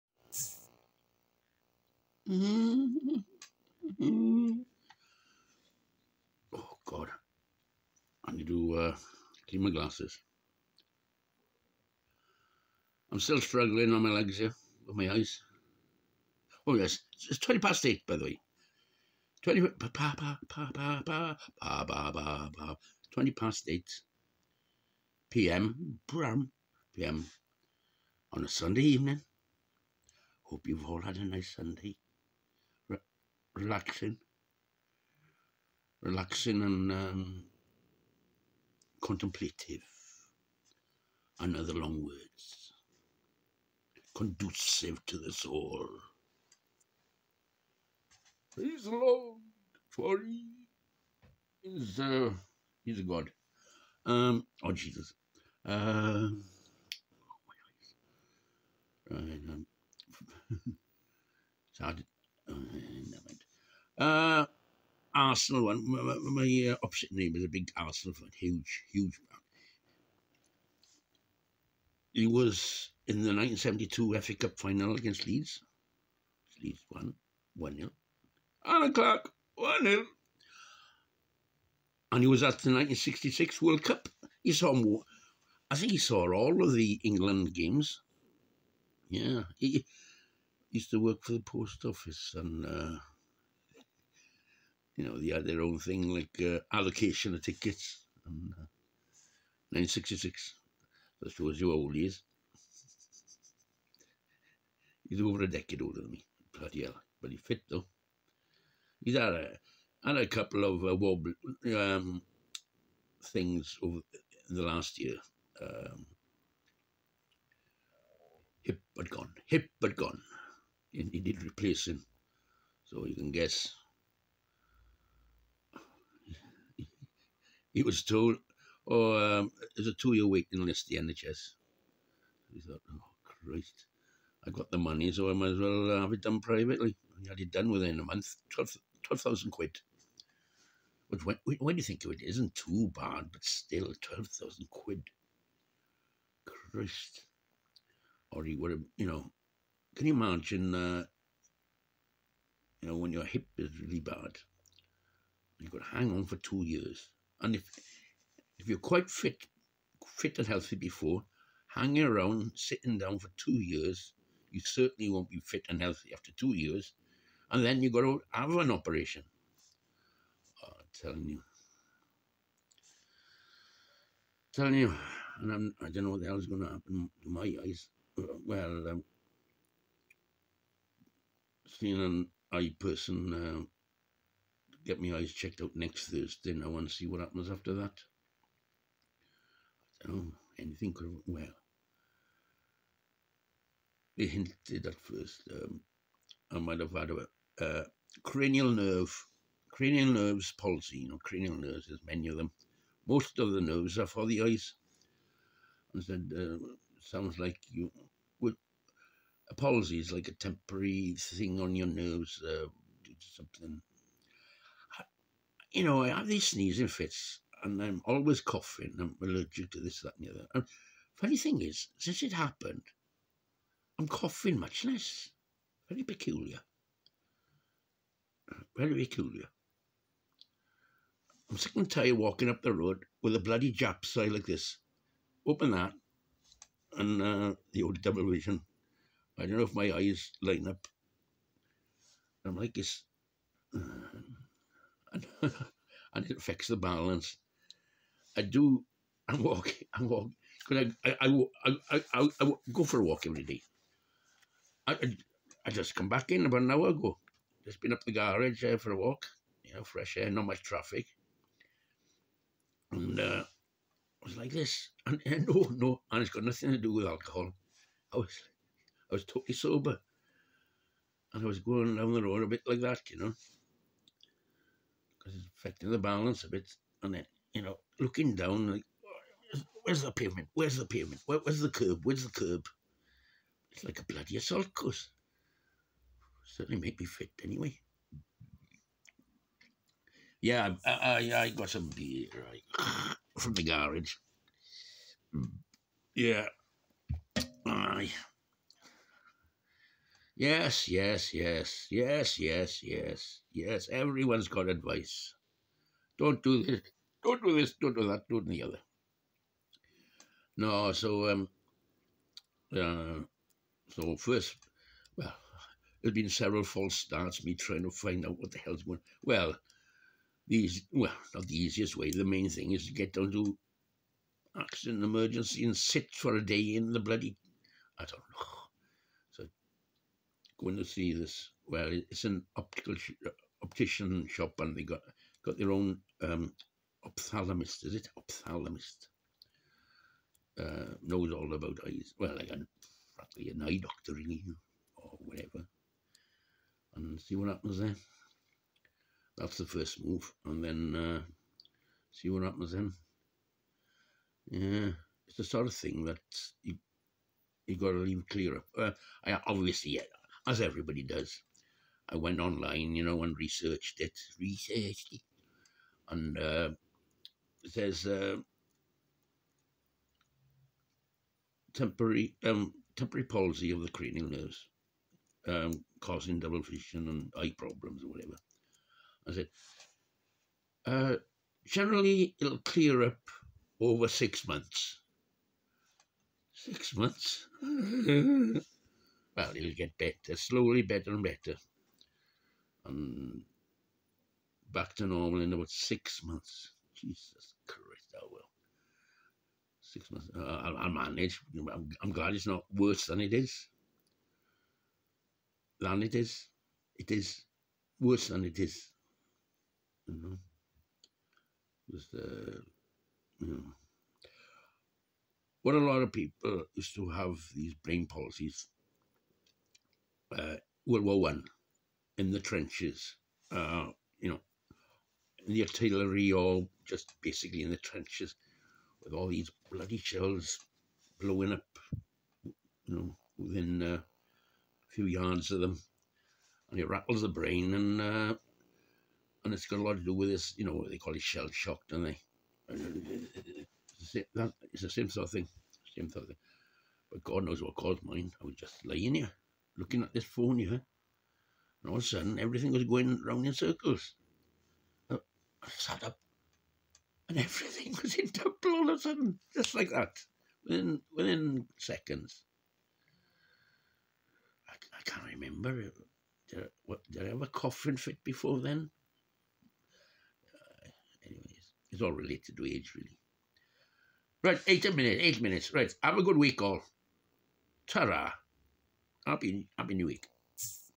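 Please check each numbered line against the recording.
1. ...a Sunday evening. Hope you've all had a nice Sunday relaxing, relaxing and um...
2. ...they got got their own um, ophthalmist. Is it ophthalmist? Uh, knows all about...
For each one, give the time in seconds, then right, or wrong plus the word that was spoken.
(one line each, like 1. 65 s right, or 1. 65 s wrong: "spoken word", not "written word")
1. 28 s right
2. 334 s right.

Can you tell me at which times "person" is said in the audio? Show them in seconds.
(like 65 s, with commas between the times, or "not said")
182 s.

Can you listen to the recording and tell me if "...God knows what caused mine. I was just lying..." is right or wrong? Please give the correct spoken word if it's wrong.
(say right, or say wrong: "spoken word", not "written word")
right.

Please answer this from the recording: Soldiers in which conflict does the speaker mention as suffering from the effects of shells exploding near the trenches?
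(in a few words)
World War One.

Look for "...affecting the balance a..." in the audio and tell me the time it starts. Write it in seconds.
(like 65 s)
275 s.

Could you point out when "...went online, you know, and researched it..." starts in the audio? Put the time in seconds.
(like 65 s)
362 s.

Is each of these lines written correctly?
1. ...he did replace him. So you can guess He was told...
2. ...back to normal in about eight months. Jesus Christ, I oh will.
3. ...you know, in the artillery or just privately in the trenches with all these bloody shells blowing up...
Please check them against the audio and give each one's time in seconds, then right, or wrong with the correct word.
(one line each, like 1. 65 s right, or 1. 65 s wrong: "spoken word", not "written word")
1. 121 s right
2. 394 s wrong: "six", not "eight"
3. 424 s wrong: "basically", not "privately".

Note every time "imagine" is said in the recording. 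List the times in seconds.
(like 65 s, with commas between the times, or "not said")
150 s.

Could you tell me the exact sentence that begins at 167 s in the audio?
And then you've got to have an operation.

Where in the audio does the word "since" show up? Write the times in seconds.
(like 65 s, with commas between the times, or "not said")
221 s.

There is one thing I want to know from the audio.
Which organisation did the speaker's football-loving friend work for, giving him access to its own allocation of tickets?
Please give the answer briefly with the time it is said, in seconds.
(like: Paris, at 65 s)
The post office, at 91 s.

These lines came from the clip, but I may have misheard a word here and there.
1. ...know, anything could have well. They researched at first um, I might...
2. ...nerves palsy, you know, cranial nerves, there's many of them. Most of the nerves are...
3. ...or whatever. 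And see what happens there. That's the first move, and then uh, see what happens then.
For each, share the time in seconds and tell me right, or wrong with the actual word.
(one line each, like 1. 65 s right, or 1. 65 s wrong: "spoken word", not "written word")
1. 190 s wrong: "hinted", not "researched"
2. 200 s right
3. 344 s right.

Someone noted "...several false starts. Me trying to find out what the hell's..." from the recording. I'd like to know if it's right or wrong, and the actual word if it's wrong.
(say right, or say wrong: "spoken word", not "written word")
right.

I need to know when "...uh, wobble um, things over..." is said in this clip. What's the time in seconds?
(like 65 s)
110 s.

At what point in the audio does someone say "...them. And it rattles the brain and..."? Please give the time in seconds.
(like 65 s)
435 s.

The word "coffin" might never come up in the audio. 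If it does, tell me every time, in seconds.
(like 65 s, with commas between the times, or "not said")
467 s.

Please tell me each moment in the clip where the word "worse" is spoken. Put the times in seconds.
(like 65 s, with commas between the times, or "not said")
402 s, 407 s.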